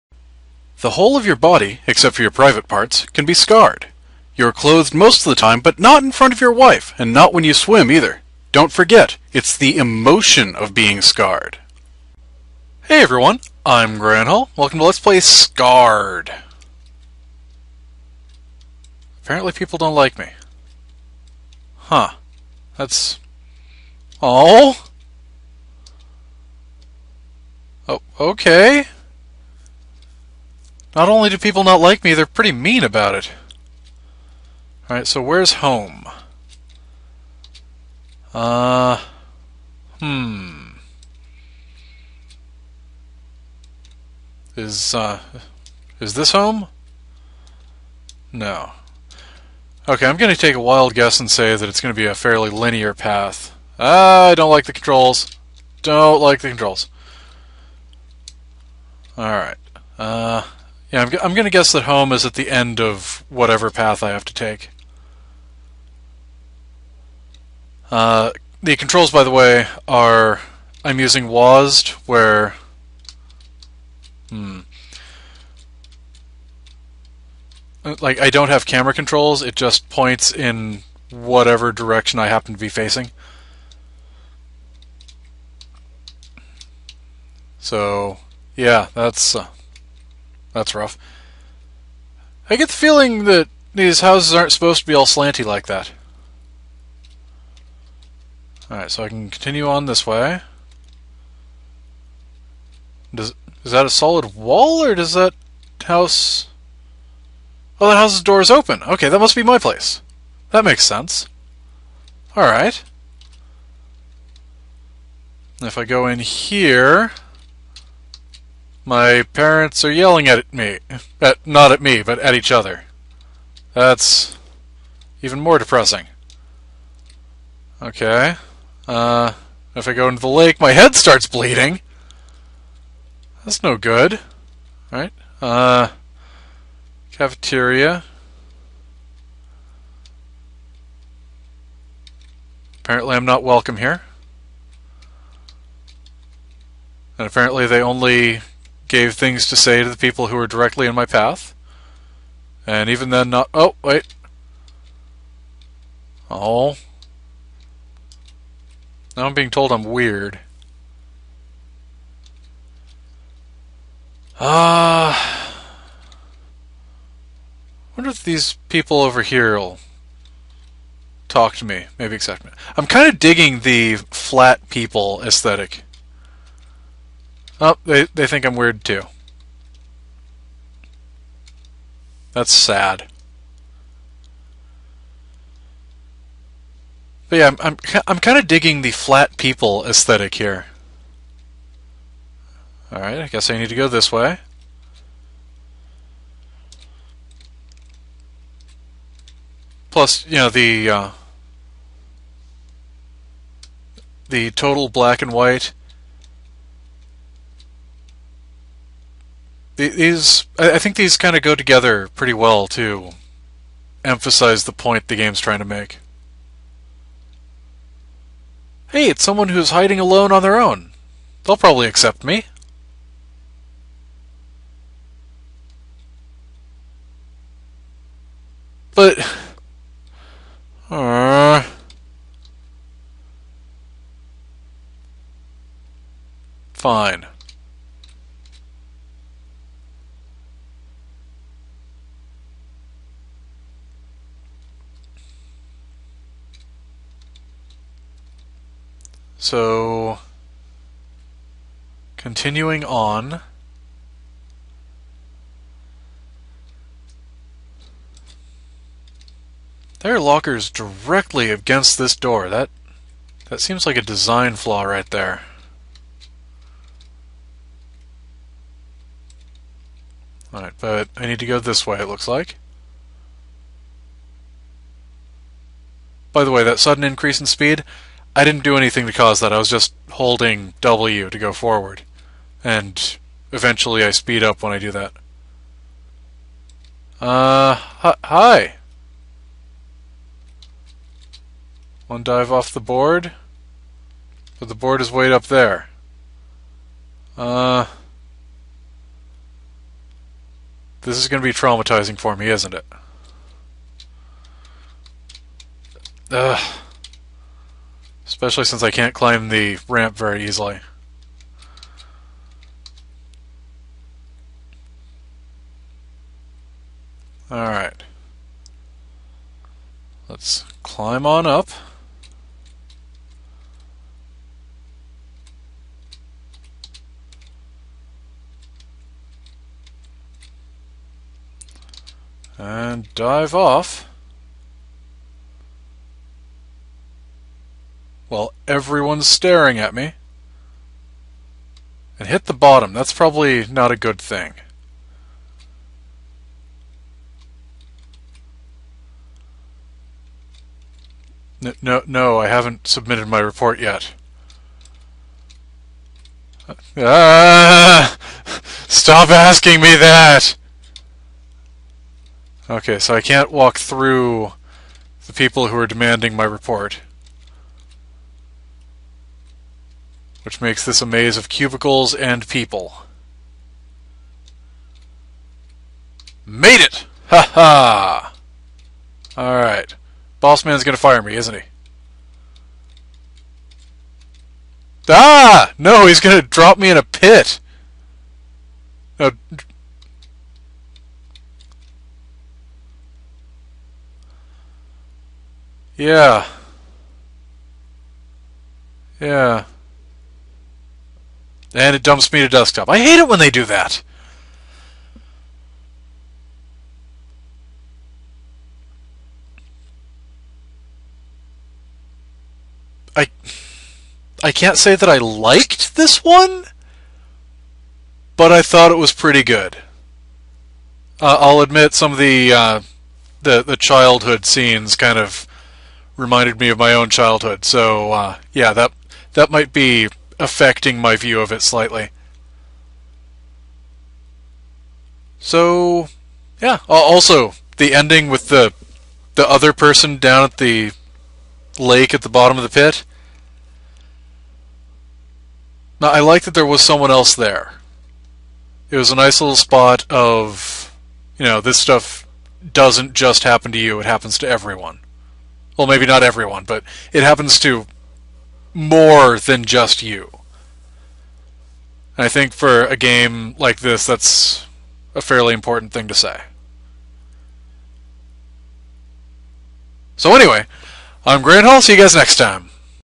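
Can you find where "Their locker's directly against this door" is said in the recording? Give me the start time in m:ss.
4:19.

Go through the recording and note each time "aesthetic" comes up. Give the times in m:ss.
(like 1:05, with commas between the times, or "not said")
2:55, 3:09.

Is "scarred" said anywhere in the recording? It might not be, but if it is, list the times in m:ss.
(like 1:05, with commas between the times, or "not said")
0:03, 0:11, 0:15.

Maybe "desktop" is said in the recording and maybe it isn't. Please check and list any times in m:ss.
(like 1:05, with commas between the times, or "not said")
6:42.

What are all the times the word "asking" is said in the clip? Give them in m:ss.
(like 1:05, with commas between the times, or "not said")
5:59.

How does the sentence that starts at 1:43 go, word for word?
Does Is that a solid wall, or does that house...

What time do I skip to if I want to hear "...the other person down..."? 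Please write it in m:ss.
7:19.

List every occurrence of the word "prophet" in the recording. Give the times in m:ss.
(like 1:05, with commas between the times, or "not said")
not said.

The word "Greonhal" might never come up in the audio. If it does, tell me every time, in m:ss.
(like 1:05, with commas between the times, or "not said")
0:13, 7:51.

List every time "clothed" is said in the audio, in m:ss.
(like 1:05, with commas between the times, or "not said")
0:04.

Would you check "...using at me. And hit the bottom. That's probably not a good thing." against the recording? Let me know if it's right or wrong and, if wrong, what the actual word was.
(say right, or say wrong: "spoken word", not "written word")
wrong: "staring", not "using".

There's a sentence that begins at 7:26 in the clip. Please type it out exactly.
Now, I like that there was someone else there.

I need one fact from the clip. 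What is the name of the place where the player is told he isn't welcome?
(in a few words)
Cafeteria.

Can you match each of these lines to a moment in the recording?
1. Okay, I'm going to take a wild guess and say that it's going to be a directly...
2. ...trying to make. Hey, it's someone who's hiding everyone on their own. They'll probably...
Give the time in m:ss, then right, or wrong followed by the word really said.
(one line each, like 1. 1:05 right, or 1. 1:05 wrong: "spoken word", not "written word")
1. 0:49 wrong: "fairly", not "directly"
2. 3:35 wrong: "alone", not "everyone".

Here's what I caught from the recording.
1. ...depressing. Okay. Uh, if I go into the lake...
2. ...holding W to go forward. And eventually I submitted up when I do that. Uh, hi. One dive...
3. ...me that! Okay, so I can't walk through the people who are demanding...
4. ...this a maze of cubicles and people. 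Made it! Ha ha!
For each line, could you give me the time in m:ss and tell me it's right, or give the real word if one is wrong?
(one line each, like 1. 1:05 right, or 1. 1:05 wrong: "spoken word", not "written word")
1. 2:05 right
2. 4:40 wrong: "speed", not "submitted"
3. 5:59 right
4. 6:10 right.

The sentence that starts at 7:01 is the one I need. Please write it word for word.
Uh, I'll admit some of the uh, the the childhood scenes kind of reminded me of my own childhood.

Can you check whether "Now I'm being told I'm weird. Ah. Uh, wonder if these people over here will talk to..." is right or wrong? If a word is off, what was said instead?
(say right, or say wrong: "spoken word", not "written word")
right.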